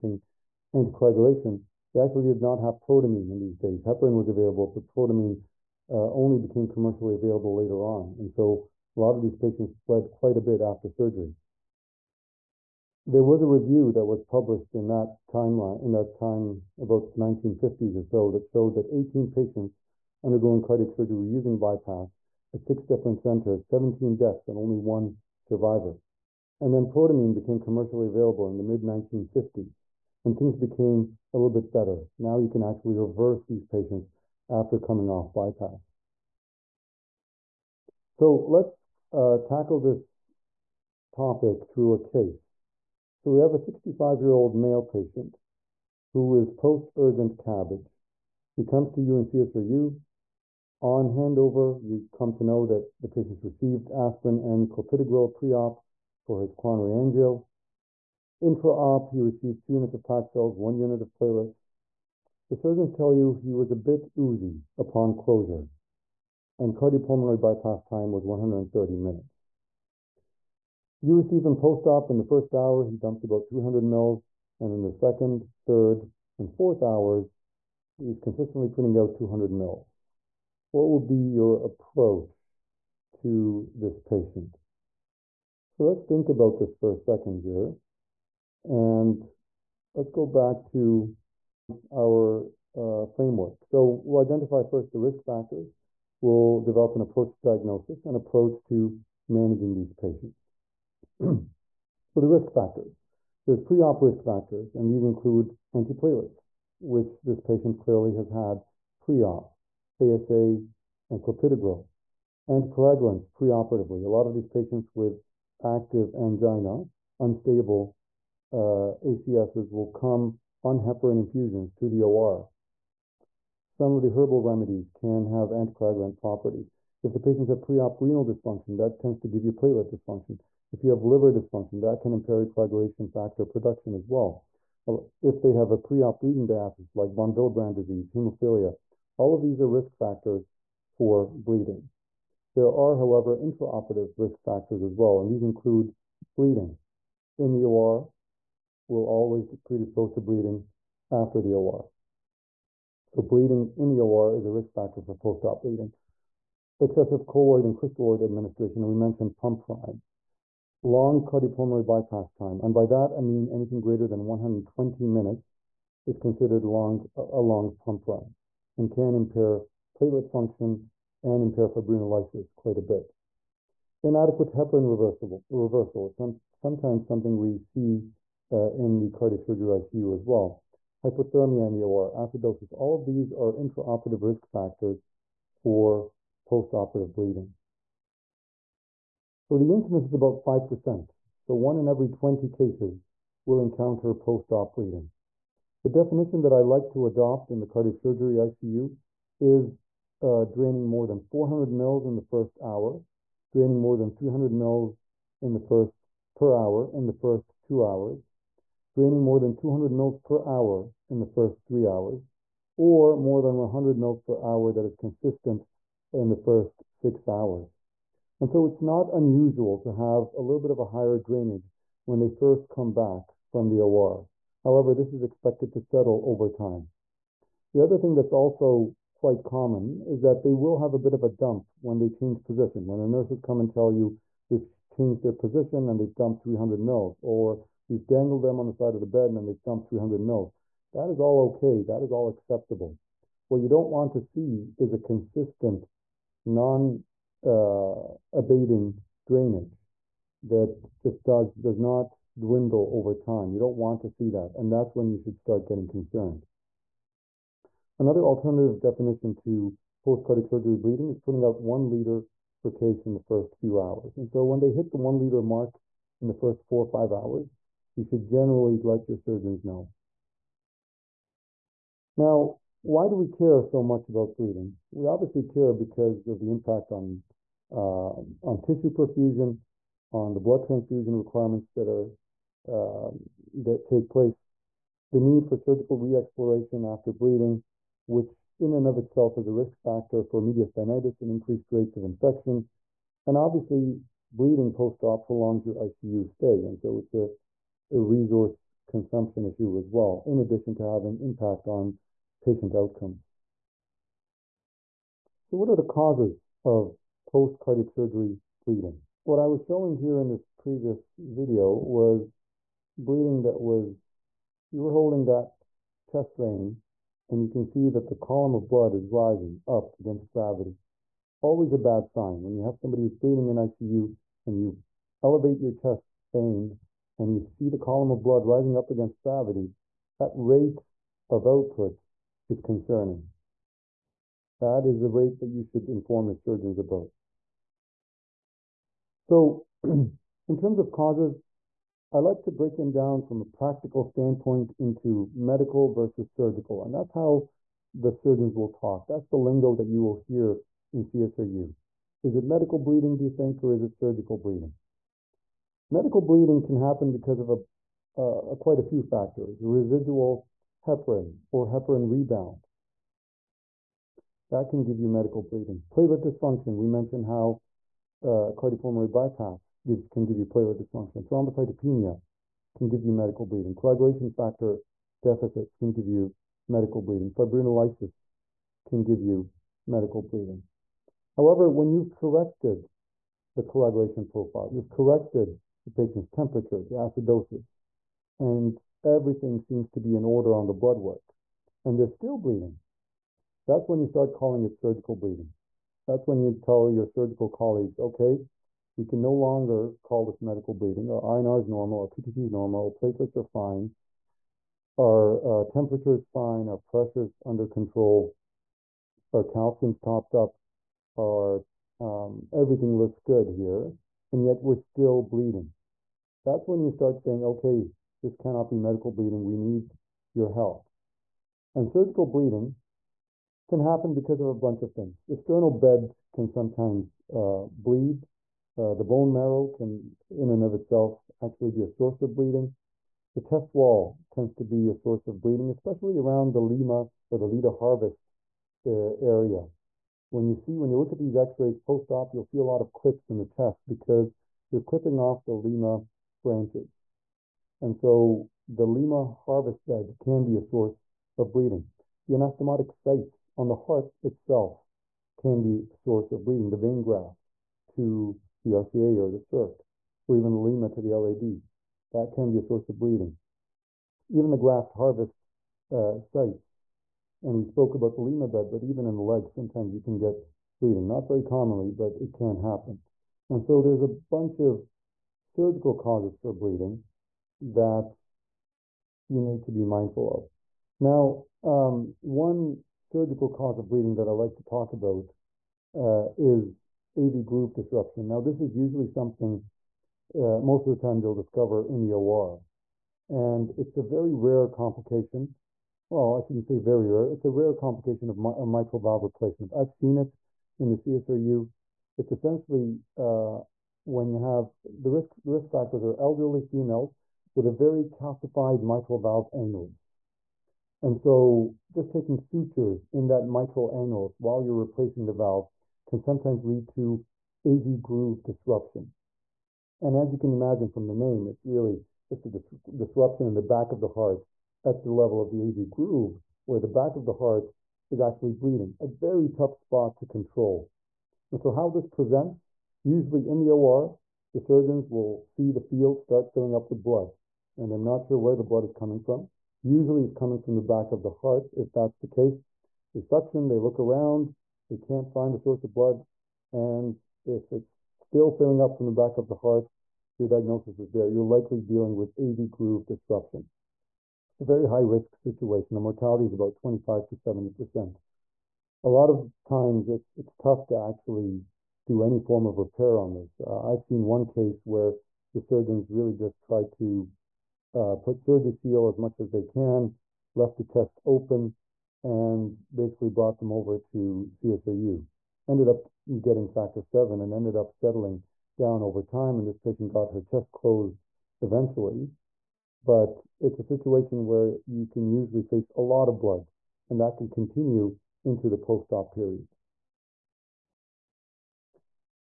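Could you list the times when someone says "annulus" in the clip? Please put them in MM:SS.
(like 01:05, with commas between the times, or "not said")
08:29, 08:33.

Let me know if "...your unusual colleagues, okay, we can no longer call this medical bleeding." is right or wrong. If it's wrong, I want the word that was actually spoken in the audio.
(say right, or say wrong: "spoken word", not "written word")
wrong: "surgical", not "unusual".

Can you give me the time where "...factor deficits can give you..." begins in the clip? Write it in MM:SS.
06:14.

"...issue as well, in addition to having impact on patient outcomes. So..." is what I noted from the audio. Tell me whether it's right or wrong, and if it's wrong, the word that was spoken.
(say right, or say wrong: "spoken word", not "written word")
right.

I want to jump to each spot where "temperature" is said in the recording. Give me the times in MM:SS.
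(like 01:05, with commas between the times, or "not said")
06:26, 06:45.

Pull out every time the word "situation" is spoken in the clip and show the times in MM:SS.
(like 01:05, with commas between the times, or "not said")
09:15, 09:43.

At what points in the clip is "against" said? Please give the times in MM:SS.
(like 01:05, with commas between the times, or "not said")
05:19, 05:28.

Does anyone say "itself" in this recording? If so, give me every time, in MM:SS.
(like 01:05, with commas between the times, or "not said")
04:48, 07:10, 07:34.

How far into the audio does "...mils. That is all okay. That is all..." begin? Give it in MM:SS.
04:00.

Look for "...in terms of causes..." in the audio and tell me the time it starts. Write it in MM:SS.
05:39.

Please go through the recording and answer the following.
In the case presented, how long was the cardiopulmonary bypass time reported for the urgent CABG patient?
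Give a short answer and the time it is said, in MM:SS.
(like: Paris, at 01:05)
130 minutes, at 01:08.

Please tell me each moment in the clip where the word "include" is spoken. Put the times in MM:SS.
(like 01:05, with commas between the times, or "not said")
01:45, 02:25.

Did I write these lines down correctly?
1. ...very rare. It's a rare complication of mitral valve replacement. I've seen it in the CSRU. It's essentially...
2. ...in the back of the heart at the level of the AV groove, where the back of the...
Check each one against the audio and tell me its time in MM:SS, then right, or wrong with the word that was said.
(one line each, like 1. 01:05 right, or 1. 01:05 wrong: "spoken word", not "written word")
1. 08:16 right
2. 08:43 right.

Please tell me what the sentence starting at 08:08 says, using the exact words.
Now, this is usually something uh, most of the time they'll discover in the OR.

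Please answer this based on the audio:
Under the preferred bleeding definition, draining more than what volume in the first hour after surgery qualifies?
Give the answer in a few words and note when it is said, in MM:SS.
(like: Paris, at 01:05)
400 mils, at 03:21.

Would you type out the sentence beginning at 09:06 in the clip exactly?
And if it's still filling up from the back of the heart, your diagnosis is there.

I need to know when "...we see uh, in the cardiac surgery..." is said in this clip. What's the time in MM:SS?
02:57.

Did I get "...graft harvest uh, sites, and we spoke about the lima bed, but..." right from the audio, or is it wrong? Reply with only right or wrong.
right.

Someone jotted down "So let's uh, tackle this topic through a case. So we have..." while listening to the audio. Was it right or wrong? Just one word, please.
right.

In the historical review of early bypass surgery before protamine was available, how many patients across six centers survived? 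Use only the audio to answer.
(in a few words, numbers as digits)
1.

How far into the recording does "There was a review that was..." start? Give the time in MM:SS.
00:13.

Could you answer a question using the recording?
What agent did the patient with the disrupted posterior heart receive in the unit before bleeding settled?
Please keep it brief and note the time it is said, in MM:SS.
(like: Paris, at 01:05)
factor 7, at 09:36.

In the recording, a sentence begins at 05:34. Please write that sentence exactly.
That is the rate that you should inform your surgeons about.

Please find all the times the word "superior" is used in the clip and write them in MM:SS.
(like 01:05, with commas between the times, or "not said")
not said.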